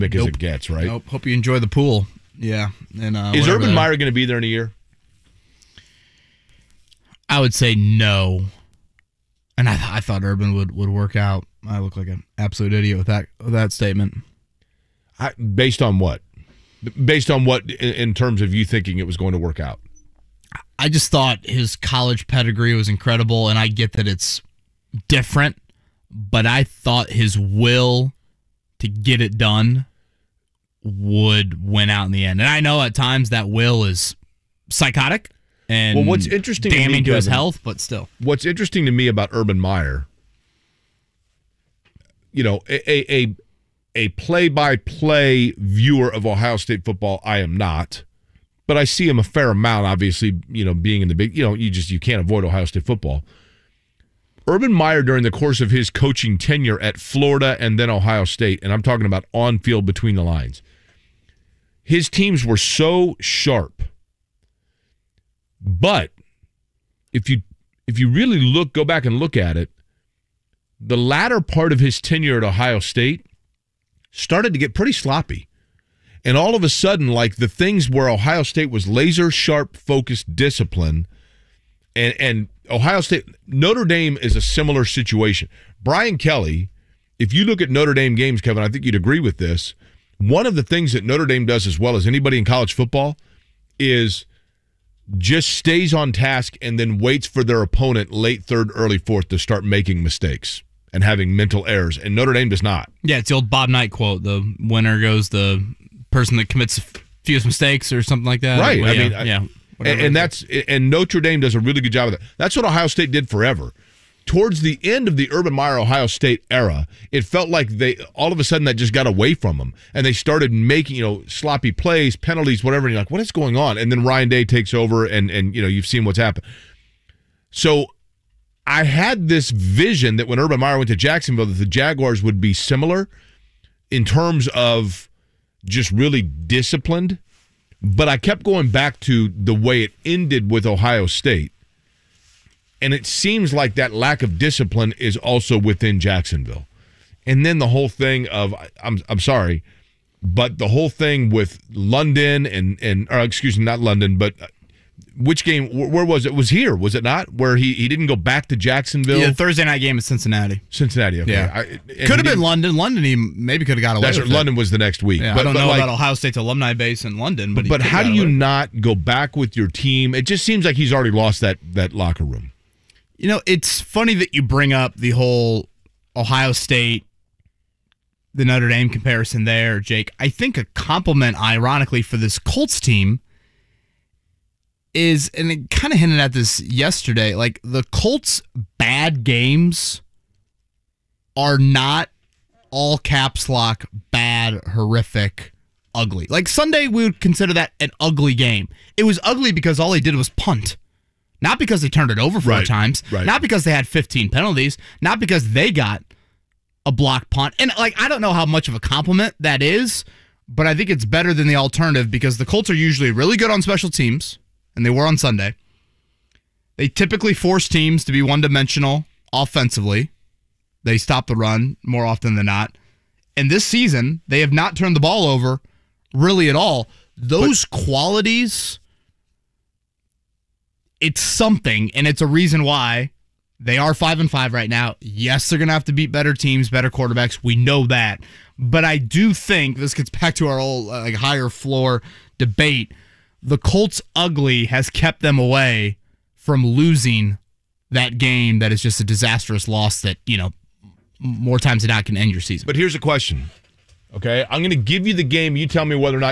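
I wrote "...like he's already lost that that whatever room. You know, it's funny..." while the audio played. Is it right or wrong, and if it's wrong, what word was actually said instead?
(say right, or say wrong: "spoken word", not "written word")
wrong: "locker", not "whatever".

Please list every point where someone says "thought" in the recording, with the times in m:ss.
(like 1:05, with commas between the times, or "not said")
0:10, 0:21, 0:26.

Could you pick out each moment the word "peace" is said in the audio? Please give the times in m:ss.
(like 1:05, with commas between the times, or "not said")
not said.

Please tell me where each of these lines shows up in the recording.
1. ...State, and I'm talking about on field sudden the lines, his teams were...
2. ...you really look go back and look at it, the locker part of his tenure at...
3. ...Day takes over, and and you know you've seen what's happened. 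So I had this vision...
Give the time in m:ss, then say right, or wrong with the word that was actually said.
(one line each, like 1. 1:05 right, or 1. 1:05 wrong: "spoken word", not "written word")
1. 0:58 wrong: "between", not "sudden"
2. 1:07 wrong: "latter", not "locker"
3. 2:04 right.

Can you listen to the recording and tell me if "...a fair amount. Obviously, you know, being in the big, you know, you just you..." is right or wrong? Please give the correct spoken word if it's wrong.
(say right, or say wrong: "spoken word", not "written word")
right.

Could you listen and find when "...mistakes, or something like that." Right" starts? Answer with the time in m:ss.
1:47.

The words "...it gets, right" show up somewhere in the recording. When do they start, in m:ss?
0:00.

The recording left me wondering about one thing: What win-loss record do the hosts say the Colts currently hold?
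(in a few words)
5-5.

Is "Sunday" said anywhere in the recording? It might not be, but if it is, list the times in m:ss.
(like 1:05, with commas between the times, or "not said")
3:16, 3:35.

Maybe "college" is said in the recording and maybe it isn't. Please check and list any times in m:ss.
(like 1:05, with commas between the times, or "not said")
0:21, 1:32.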